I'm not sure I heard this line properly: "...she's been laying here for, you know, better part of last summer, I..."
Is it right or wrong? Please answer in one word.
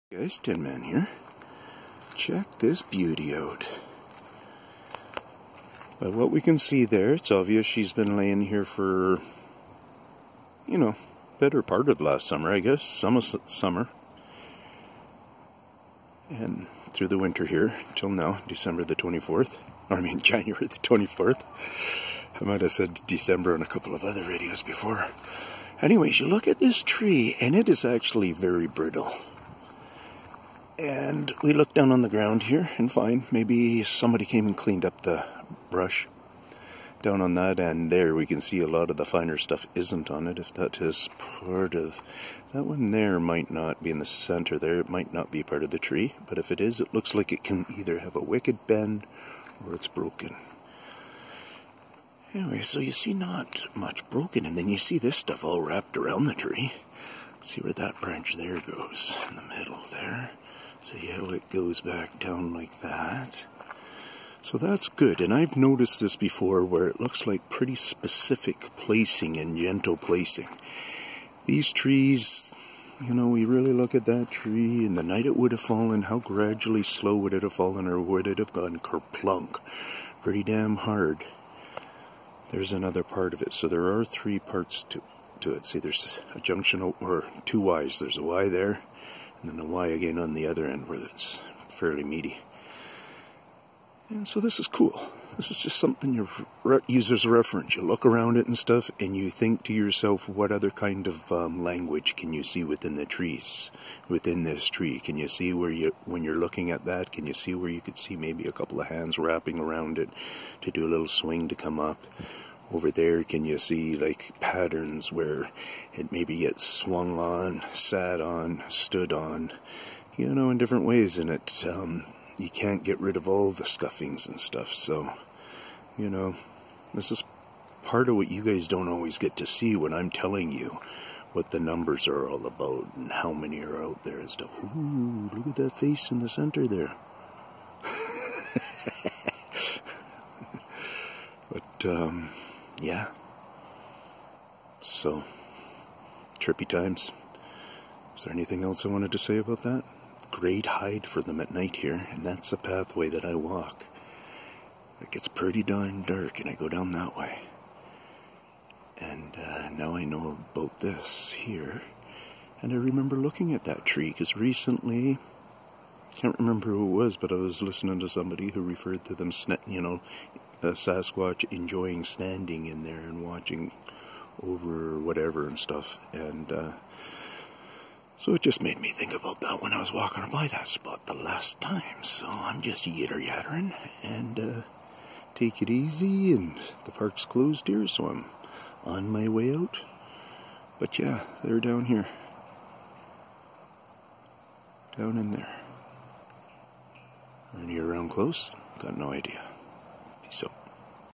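right.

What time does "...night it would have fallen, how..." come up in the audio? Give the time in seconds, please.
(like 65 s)
75 s.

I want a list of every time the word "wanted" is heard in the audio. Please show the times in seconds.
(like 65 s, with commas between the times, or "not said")
148 s.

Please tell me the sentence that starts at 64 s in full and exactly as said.
So that's good, and I've noticed this before where it looks like pretty specific placing and gentle placing.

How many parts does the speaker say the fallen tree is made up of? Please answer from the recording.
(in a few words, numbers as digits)
3.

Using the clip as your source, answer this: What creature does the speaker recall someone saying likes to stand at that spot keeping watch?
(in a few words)
Sasquatch.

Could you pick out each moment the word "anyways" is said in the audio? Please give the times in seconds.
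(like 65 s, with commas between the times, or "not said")
25 s, 52 s.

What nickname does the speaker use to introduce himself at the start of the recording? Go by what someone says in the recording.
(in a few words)
Tin Man.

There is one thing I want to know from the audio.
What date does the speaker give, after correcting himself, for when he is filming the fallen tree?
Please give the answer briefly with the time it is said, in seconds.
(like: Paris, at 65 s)
January 24th, at 20 s.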